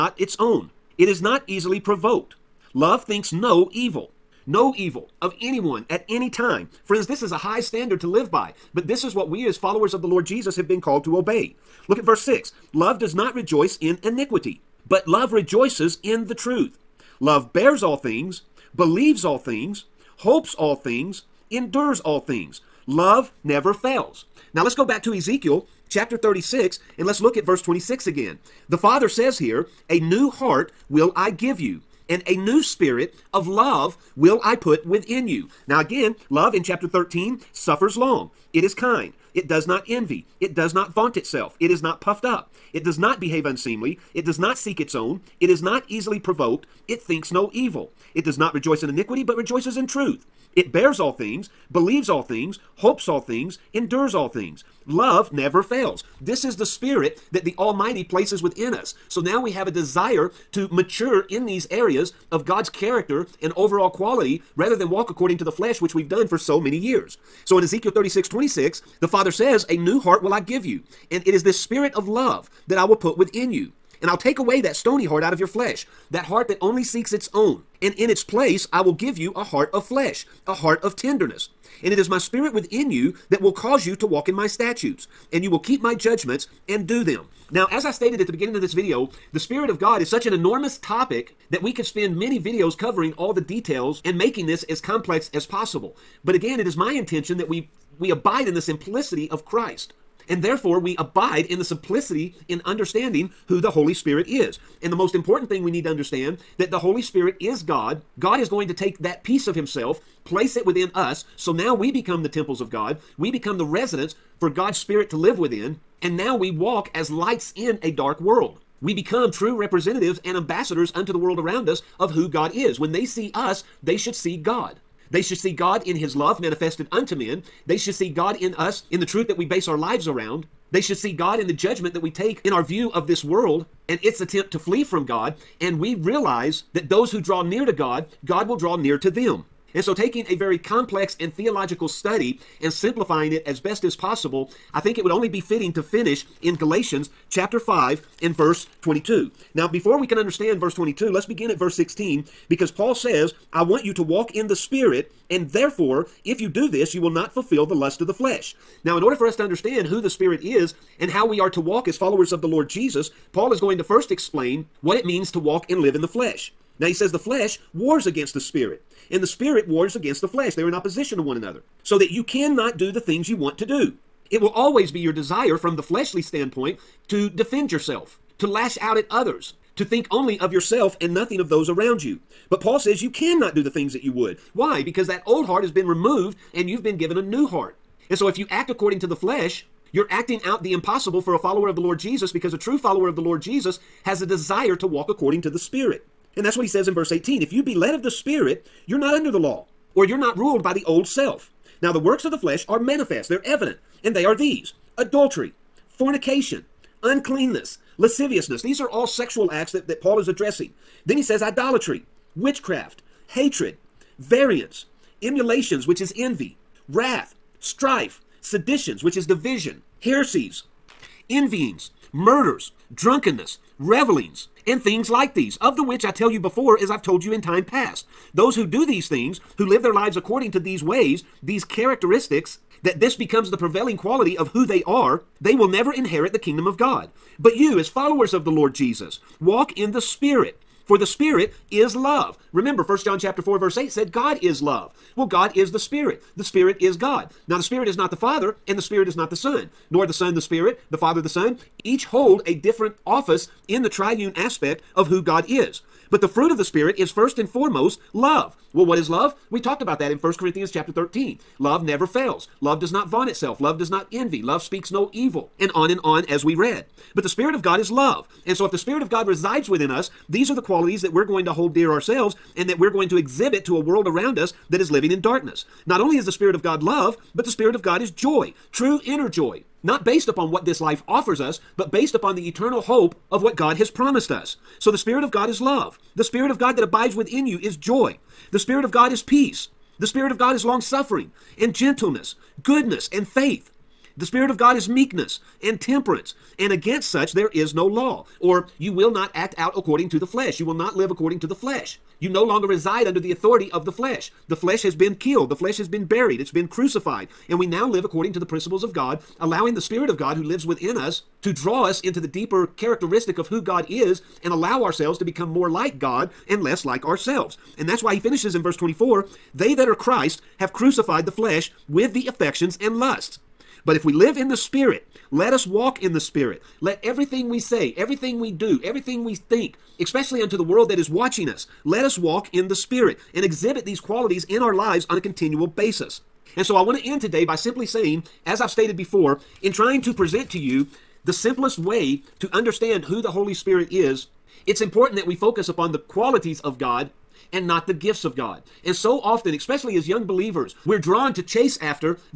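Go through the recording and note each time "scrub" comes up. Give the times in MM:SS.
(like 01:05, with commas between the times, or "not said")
not said.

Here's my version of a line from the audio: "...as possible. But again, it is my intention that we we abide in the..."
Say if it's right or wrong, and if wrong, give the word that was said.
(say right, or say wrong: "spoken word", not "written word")
right.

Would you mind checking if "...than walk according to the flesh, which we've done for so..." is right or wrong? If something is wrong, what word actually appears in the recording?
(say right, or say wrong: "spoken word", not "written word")
right.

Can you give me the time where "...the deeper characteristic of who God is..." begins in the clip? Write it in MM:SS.
05:12.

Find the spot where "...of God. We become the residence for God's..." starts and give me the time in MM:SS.
01:52.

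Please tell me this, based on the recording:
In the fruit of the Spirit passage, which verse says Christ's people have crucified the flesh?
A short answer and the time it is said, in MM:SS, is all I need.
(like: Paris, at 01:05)
verse 24, at 05:18.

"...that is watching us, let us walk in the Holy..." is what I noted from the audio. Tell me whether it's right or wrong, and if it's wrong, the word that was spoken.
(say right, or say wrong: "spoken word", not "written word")
wrong: "Spirit", not "Holy".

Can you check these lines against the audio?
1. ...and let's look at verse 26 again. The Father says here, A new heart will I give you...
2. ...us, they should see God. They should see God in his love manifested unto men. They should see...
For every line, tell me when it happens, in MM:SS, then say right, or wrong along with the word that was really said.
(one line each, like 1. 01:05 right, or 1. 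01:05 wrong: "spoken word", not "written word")
1. 00:26 right
2. 02:03 right.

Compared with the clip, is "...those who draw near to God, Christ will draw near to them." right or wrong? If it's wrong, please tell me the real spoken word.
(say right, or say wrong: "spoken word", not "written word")
wrong: "God", not "Christ".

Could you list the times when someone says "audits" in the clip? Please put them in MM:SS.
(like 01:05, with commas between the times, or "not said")
not said.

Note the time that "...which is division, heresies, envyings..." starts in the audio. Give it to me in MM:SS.
03:39.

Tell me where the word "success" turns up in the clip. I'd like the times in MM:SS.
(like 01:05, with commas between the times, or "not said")
not said.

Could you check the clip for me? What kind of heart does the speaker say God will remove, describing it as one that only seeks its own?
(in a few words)
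stony heart.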